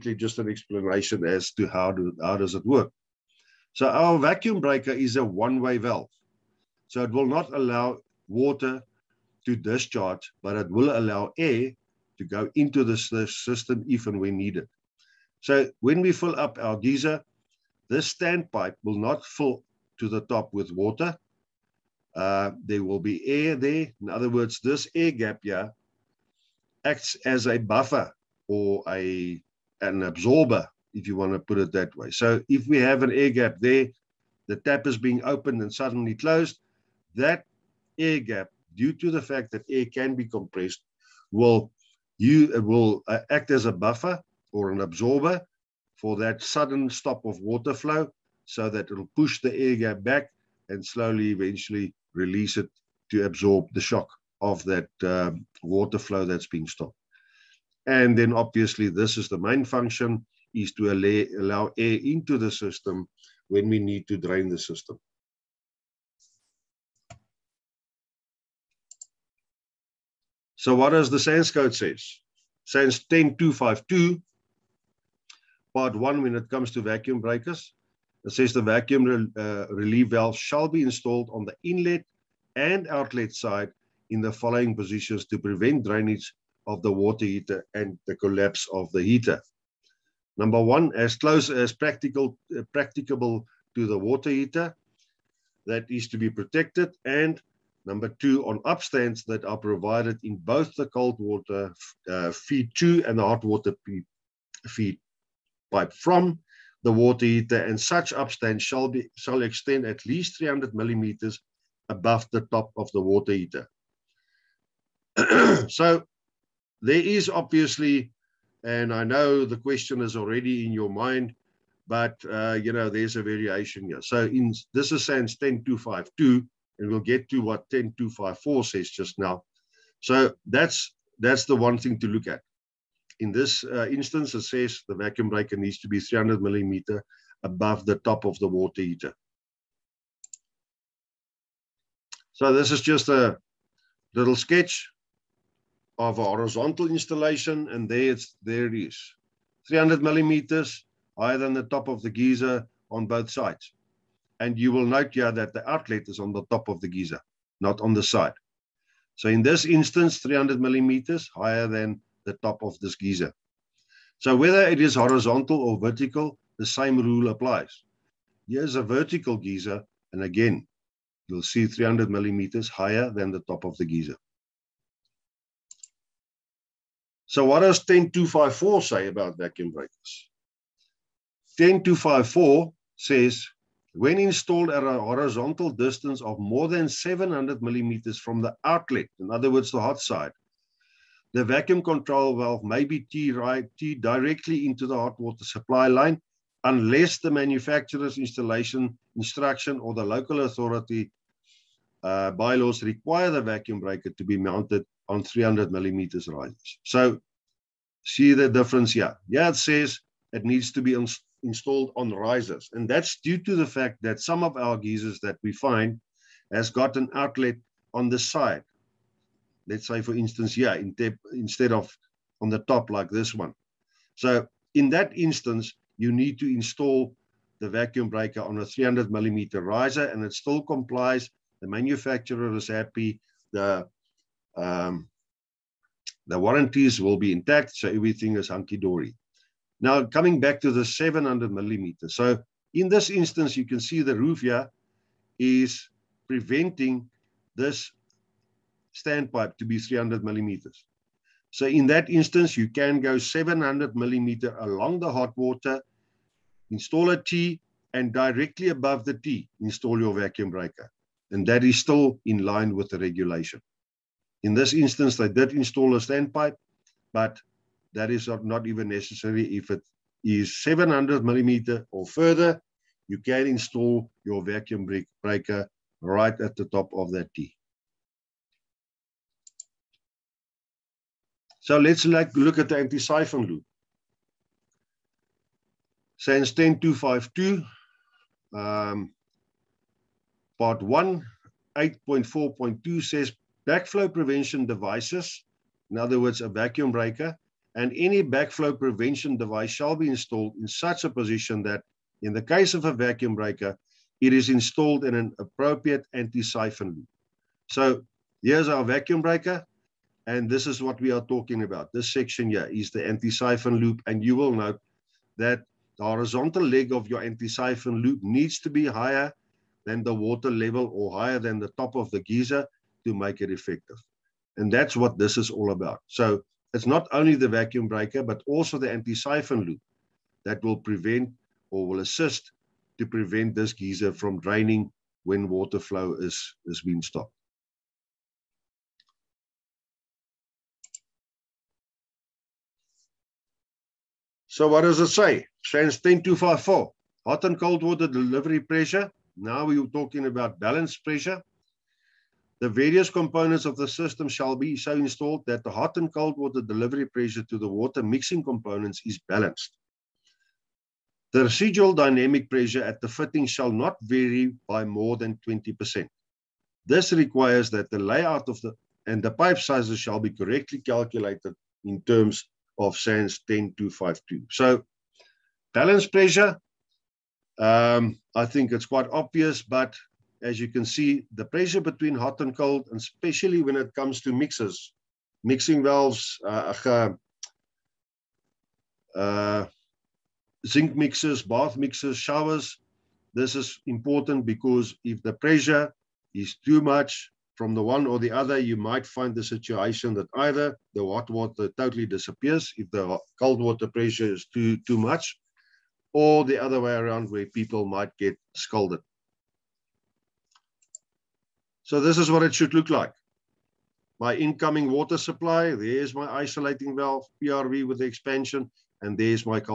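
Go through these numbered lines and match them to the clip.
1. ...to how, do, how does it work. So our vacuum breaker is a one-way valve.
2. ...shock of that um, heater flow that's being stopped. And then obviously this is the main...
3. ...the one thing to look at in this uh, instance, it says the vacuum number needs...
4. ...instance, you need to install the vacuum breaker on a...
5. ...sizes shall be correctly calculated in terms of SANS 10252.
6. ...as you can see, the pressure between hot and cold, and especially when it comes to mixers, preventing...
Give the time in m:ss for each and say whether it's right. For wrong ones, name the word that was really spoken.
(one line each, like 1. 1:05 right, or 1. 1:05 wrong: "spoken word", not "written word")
1. 0:01 right
2. 0:53 wrong: "water", not "heater"
3. 2:11 wrong: "breaker", not "number"
4. 3:45 right
5. 6:09 right
6. 6:20 wrong: "mixing", not "preventing".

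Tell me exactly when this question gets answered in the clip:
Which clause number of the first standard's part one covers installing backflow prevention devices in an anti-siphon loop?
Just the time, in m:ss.
4:51.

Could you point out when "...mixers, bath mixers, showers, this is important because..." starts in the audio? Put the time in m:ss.
6:30.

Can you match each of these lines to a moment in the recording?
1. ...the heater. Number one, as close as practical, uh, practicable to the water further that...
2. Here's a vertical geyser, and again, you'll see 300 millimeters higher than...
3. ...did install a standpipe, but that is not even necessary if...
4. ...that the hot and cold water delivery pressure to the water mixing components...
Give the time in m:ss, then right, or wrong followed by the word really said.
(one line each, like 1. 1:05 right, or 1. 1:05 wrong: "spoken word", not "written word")
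1. 1:28 wrong: "heater", not "further"
2. 2:48 right
3. 4:25 right
4. 5:55 right.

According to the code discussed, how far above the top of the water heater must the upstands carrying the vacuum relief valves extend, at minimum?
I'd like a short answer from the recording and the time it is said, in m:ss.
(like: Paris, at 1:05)
300 millimeters, at 1:49.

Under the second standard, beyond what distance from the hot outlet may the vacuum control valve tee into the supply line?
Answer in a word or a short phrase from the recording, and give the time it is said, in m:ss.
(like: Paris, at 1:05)
700 millimeters, at 3:06.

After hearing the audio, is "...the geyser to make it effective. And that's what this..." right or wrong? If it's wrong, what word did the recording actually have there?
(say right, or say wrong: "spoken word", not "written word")
right.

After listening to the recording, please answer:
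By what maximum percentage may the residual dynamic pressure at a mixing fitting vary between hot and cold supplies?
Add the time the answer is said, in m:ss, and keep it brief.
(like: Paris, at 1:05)
20%, at 6:05.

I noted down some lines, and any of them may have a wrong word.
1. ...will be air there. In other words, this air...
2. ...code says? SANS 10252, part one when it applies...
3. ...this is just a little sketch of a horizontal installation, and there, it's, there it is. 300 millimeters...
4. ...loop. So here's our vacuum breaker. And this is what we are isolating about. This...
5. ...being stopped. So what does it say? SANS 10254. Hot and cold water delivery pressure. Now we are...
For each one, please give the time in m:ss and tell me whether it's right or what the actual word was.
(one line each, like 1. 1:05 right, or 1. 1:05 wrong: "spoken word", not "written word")
1. 0:22 right
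2. 1:11 wrong: "comes", not "applies"
3. 2:22 right
4. 5:06 wrong: "talking", not "isolating"
5. 5:36 right.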